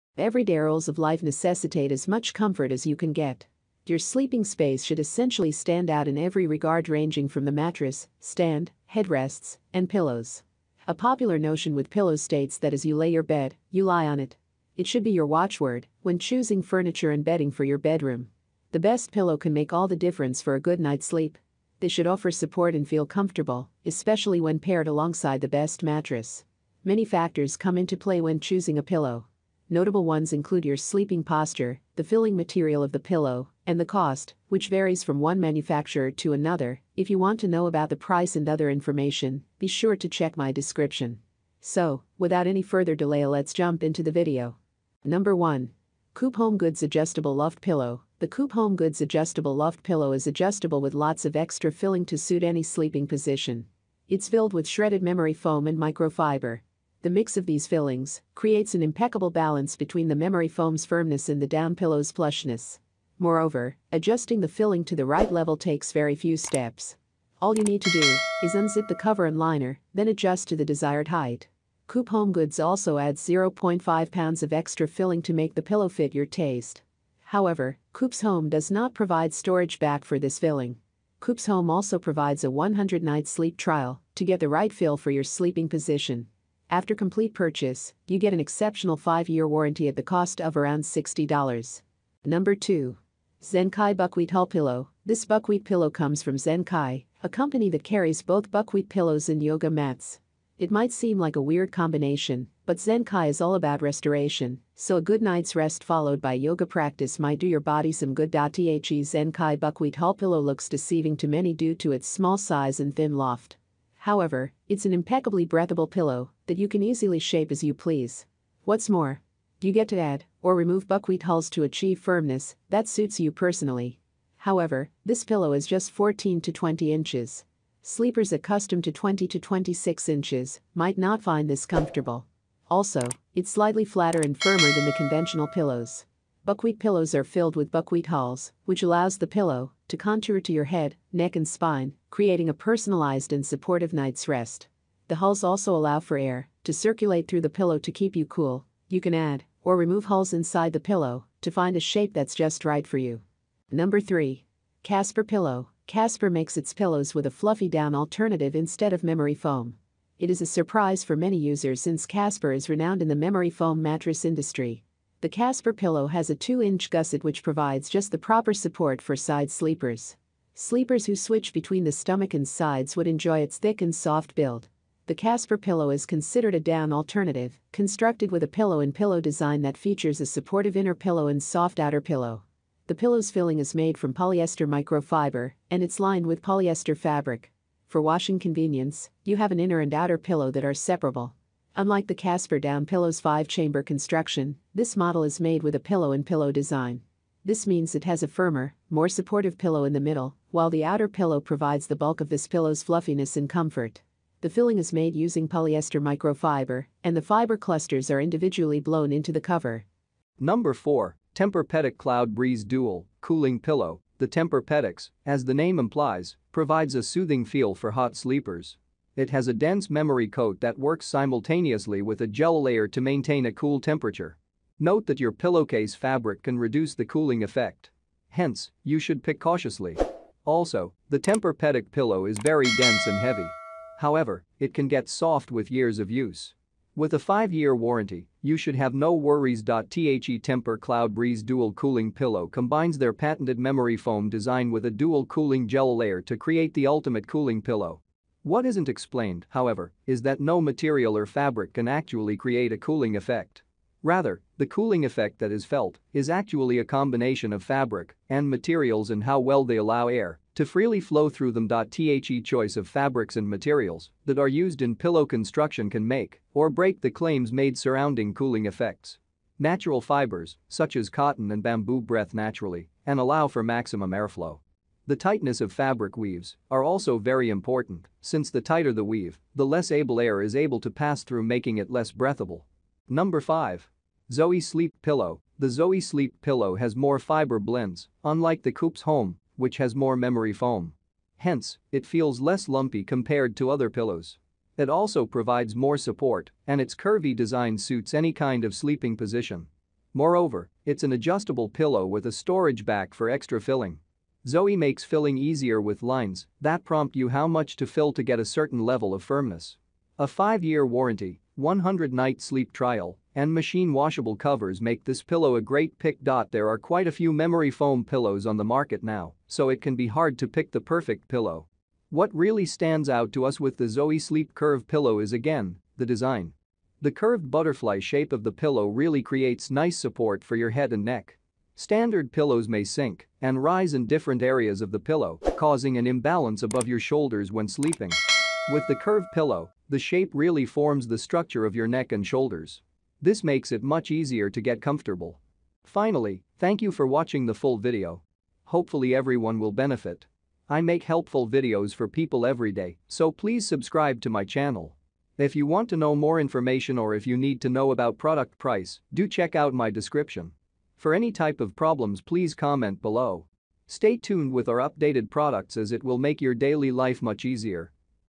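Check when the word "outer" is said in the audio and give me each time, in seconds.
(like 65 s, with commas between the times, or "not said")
181 s, 189 s, 200 s.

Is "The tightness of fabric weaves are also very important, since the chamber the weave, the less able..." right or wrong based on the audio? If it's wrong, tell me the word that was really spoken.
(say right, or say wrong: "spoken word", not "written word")
wrong: "tighter", not "chamber".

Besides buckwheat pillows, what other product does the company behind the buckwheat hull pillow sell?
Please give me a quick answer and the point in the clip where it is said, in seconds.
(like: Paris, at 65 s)
yoga mats, at 99 s.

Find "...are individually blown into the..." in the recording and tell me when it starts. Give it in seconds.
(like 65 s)
208 s.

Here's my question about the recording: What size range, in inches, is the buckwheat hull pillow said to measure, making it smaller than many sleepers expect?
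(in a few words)
14 to 20 inches.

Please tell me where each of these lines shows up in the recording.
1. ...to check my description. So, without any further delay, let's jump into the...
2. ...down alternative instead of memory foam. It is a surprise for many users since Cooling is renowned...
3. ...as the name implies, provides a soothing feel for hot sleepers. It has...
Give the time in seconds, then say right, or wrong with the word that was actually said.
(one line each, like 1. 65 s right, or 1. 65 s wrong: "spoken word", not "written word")
1. 39 s right
2. 157 s wrong: "Casper", not "Cooling"
3. 215 s right.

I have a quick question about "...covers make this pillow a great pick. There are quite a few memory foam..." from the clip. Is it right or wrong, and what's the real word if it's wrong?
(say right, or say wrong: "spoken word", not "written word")
right.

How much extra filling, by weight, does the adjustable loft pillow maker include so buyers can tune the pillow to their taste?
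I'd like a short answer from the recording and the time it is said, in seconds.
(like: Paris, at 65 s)
0.5 pounds, at 73 s.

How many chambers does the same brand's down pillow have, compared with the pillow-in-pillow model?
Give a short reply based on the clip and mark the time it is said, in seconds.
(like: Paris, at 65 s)
5, at 193 s.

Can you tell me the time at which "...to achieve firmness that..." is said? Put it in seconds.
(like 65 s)
121 s.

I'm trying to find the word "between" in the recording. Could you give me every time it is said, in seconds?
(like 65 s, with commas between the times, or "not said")
59 s, 171 s.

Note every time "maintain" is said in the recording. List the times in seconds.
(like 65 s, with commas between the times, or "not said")
223 s.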